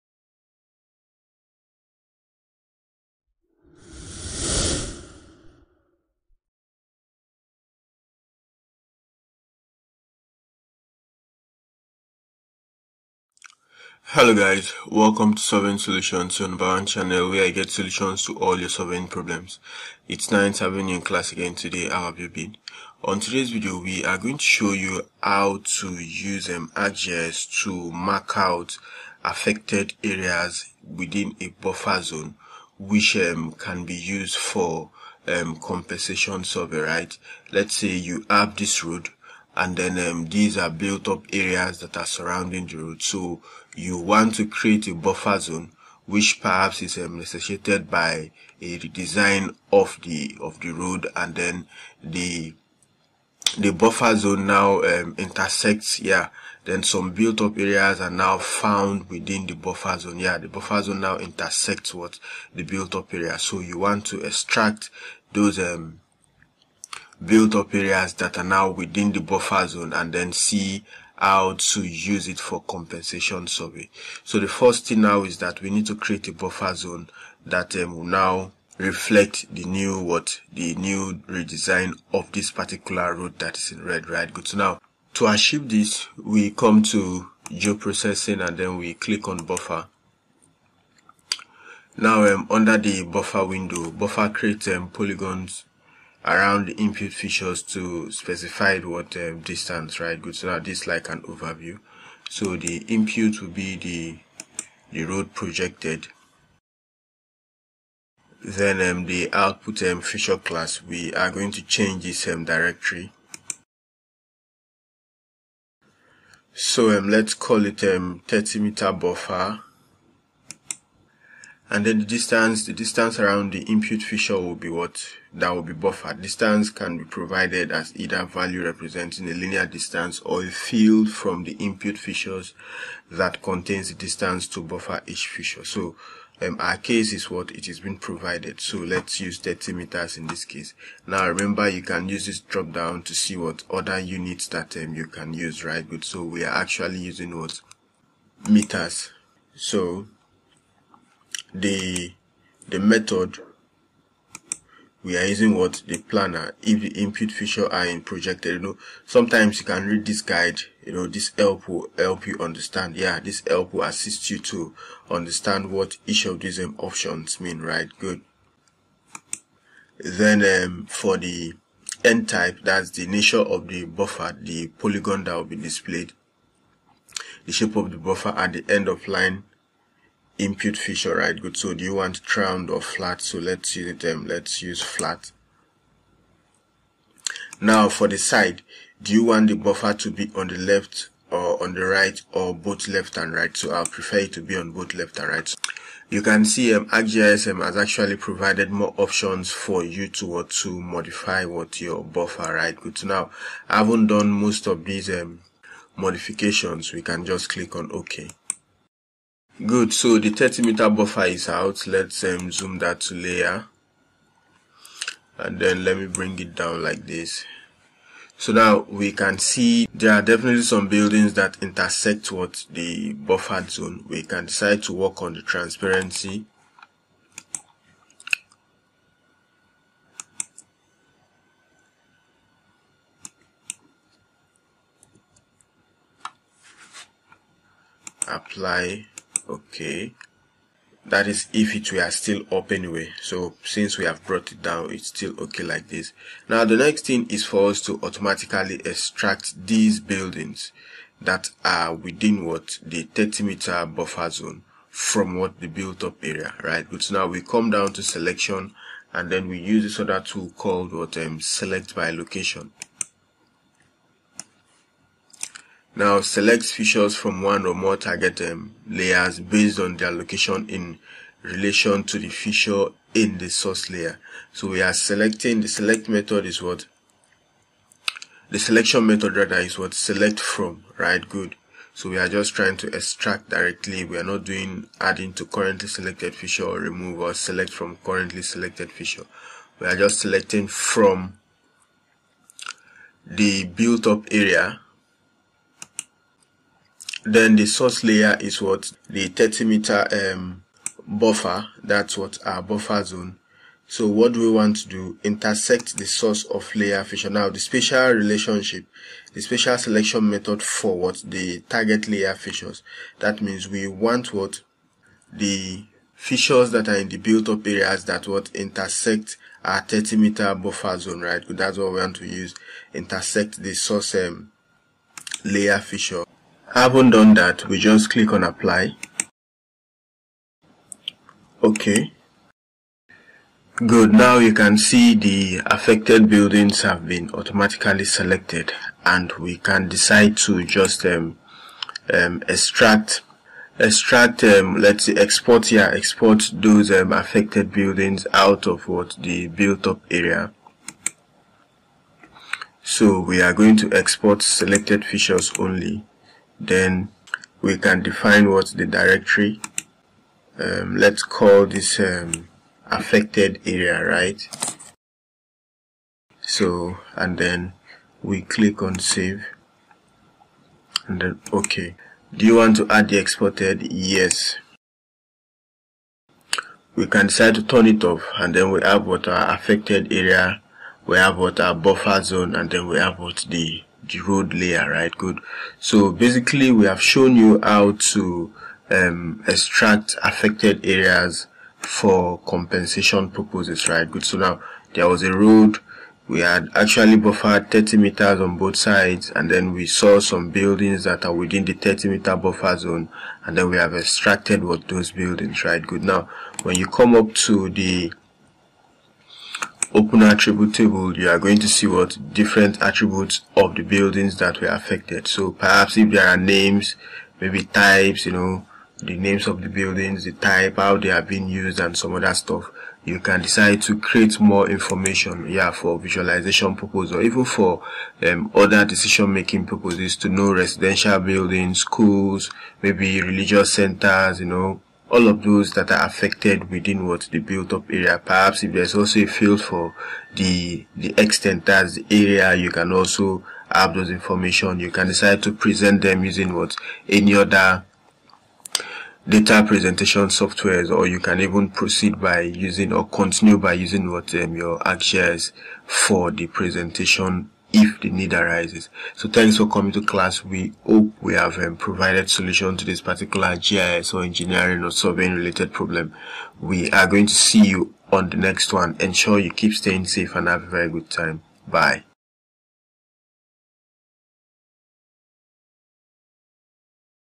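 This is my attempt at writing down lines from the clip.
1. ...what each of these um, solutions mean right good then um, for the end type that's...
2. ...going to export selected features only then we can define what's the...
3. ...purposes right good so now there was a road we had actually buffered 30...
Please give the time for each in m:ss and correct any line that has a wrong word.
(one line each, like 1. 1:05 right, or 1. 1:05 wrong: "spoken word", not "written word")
1. 2:45 wrong: "options", not "solutions"
2. 5:53 right
3. 6:33 right.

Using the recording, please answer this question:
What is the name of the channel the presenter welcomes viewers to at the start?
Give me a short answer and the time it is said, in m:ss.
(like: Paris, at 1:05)
Surveying Solutions, at 0:15.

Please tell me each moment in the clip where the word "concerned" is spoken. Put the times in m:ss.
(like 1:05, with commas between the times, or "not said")
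not said.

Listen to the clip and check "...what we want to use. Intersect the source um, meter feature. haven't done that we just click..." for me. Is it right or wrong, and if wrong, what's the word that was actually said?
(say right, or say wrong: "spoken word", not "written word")
wrong: "layer", not "meter".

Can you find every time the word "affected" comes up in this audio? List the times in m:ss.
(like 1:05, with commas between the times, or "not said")
0:29, 5:35, 5:47, 6:02, 6:19, 6:30, 6:54, 7:16.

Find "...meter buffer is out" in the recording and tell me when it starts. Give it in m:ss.
3:30.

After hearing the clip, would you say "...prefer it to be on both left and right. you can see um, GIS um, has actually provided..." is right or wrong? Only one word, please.
wrong.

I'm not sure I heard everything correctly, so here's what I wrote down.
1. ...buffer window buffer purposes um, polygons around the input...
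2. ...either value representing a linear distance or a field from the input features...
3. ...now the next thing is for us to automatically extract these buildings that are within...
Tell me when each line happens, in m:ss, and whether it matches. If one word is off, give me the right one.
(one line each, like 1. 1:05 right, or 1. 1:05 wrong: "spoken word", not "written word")
1. 1:33 wrong: "creates", not "purposes"
2. 2:07 right
3. 4:06 right.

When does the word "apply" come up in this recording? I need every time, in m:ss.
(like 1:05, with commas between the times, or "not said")
3:58, 5:28.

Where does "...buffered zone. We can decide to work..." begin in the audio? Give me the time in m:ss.
3:43.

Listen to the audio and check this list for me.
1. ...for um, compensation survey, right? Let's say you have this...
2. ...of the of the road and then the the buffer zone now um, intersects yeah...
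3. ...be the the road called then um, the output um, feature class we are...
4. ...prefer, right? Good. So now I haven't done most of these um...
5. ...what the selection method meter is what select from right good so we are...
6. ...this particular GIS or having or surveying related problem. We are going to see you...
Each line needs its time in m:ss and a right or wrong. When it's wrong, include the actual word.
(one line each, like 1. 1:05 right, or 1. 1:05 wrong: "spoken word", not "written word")
1. 0:34 right
2. 0:49 right
3. 1:43 wrong: "projected", not "called"
4. 3:22 wrong: "buffer", not "prefer"
5. 4:36 wrong: "rather", not "meter"
6. 7:42 wrong: "engineering", not "having".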